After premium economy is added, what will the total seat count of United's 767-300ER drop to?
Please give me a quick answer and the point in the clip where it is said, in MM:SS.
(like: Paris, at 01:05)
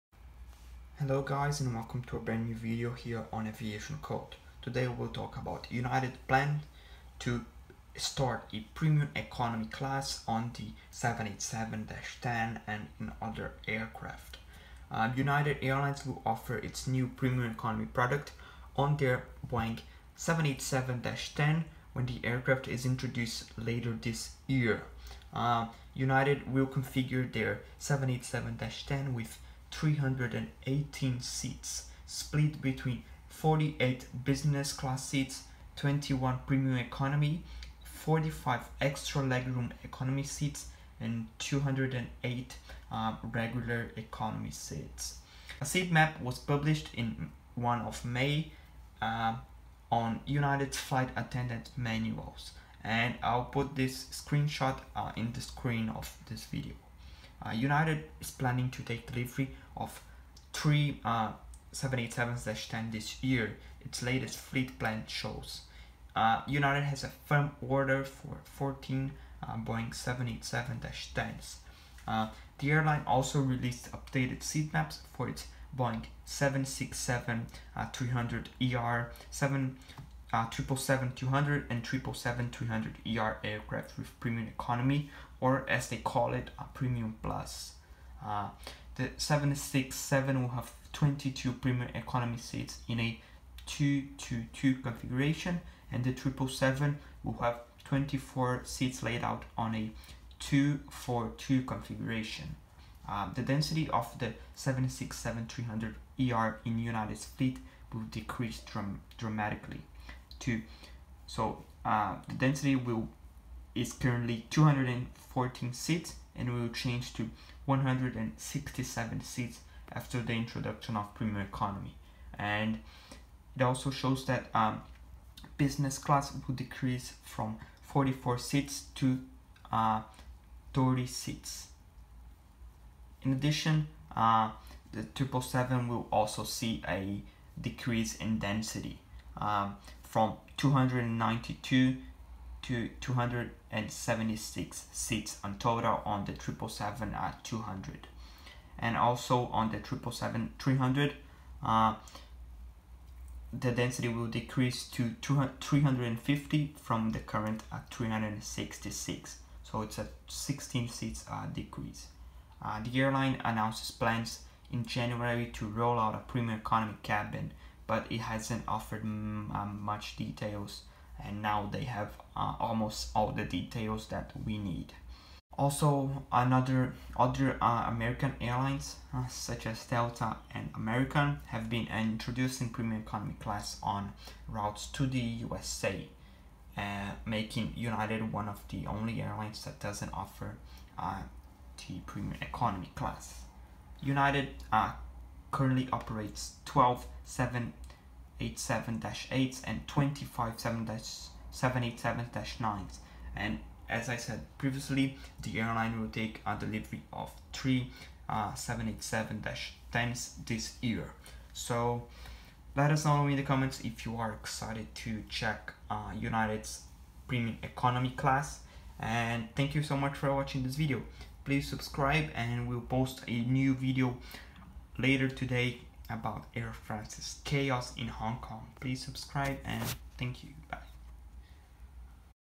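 167, at 01:57.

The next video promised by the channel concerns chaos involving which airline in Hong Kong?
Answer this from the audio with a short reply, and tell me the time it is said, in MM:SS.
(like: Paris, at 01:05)
Air France, at 03:46.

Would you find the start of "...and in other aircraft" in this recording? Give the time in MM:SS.
00:12.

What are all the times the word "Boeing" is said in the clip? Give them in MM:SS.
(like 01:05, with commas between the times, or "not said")
00:19, 01:09, 01:15.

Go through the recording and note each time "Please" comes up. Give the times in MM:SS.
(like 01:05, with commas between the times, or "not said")
03:41, 03:48.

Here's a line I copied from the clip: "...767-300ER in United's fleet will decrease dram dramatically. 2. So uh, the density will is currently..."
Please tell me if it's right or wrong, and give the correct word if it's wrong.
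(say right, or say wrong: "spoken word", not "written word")
right.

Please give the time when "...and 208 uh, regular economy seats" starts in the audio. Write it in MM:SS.
00:40.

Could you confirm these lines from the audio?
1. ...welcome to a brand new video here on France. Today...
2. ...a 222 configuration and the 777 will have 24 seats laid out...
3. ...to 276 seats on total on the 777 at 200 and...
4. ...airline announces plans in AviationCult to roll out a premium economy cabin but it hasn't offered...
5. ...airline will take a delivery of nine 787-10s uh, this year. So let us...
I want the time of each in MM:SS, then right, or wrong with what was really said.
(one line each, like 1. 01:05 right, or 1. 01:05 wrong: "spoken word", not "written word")
1. 00:01 wrong: "AviationCult", not "France"
2. 01:32 right
3. 02:22 right
4. 02:42 wrong: "January", not "AviationCult"
5. 03:25 wrong: "three", not "nine".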